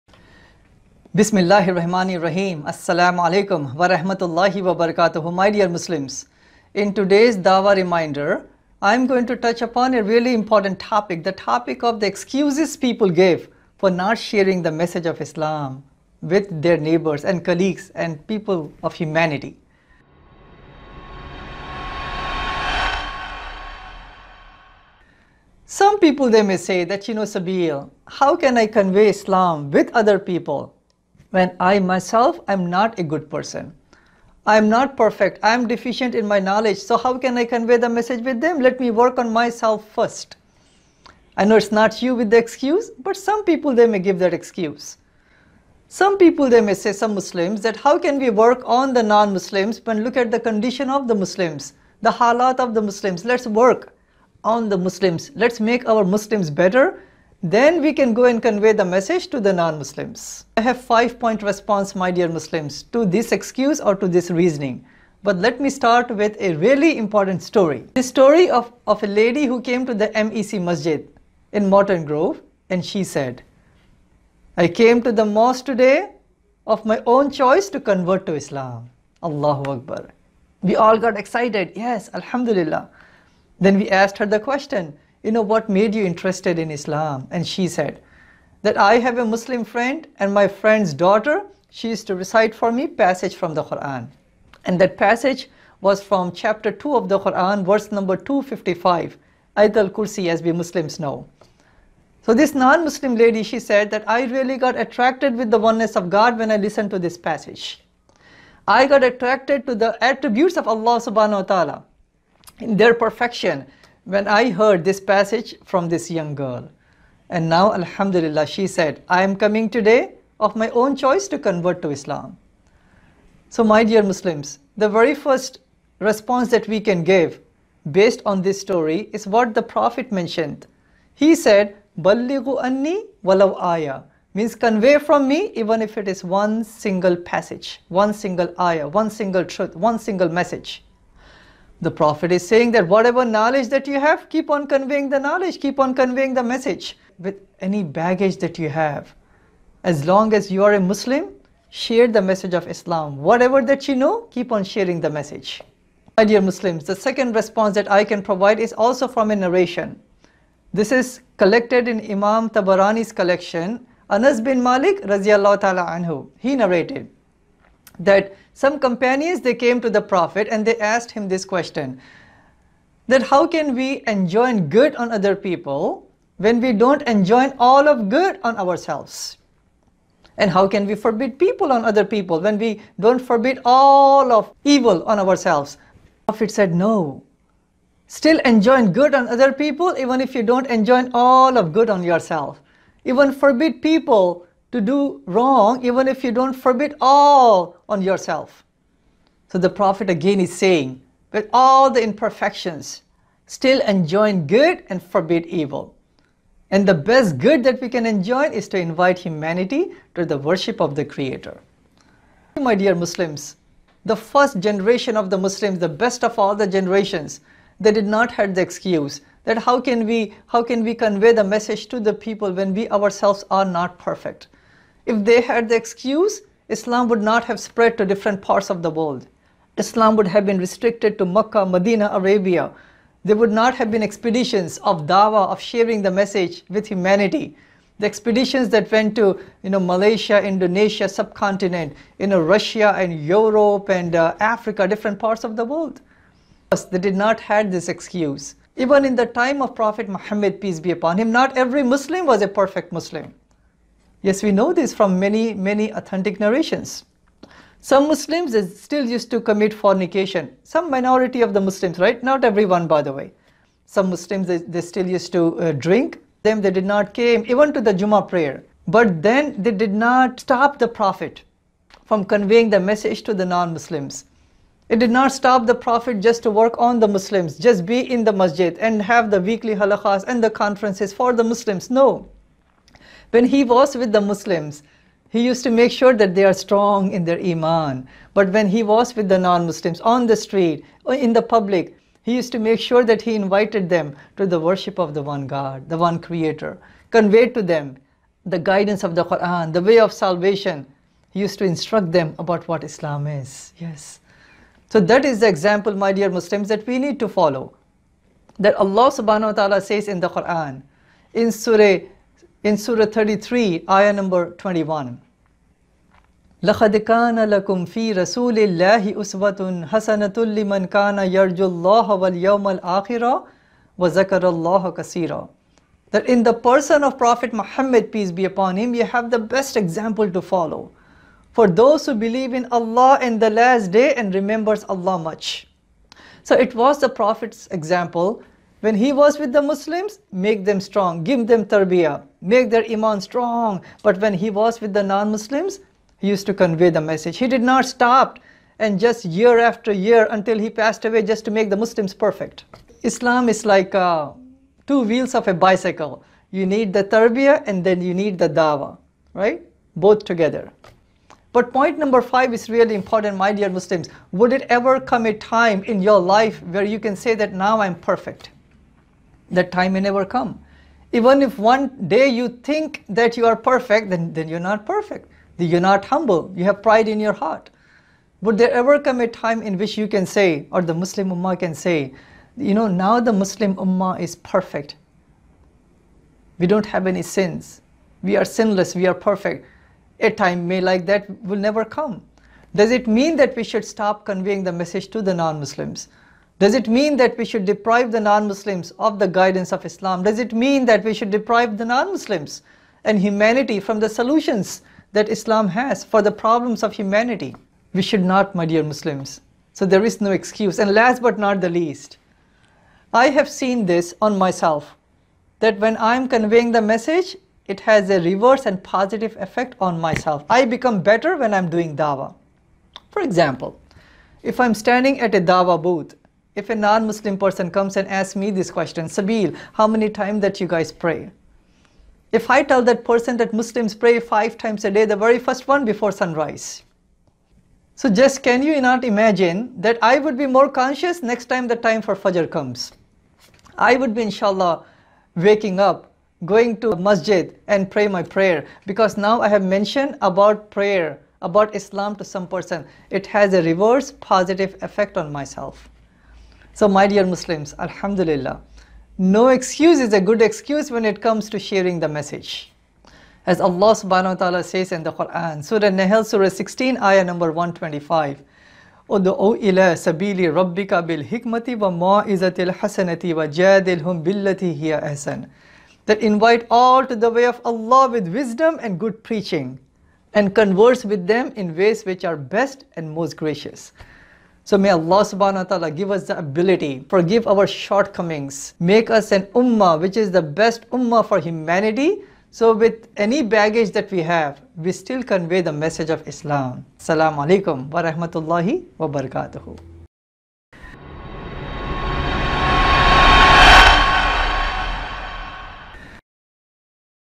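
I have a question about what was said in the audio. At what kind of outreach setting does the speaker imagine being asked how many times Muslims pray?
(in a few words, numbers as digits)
a dawa booth.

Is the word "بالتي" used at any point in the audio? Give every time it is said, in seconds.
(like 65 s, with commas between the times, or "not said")
474 s.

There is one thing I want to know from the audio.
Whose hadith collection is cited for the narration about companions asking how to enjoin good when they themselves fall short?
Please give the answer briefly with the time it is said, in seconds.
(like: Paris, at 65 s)
Imam Tabarani, at 162 s.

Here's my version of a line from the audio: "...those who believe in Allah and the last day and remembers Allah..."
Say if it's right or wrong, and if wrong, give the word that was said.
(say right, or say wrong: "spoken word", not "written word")
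right.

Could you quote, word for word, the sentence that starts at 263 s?
Some Muslims, they, they still used to uh, drink.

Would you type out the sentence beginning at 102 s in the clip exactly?
So this non-Muslim lady, she said that I really got attracted with the oneness of God when I listened to this passage.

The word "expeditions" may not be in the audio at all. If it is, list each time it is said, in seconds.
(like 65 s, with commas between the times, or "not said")
234 s, 238 s.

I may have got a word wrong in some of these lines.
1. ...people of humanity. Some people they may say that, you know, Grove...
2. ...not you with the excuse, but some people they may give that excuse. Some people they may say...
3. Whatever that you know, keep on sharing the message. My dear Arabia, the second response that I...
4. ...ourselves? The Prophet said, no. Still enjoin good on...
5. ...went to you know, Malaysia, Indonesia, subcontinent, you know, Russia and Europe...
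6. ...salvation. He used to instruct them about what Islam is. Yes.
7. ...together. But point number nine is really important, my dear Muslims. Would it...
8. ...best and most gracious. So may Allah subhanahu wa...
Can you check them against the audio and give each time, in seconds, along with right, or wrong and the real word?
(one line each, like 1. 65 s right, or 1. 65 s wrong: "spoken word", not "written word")
1. 18 s wrong: "Sabeel", not "Grove"
2. 41 s right
3. 153 s wrong: "Muslims", not "Arabia"
4. 185 s right
5. 238 s right
6. 300 s right
7. 360 s wrong: "five", not "nine"
8. 482 s right.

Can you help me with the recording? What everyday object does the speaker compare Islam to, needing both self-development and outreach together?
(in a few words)
a bicycle.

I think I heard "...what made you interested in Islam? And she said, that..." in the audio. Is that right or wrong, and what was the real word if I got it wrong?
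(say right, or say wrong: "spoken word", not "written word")
right.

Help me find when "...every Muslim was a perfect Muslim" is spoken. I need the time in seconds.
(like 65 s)
251 s.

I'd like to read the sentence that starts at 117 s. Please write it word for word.
And now, Alhamdulillah, she said, I am coming today of my own choice to convert to Islam.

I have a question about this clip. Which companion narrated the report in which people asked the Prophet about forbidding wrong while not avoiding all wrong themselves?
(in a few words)
Anas bin Malik.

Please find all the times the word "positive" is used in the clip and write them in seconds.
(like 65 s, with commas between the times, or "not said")
418 s, 454 s.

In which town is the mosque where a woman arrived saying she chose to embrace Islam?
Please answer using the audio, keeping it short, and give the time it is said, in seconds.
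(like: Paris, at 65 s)
Morton Grove, at 71 s.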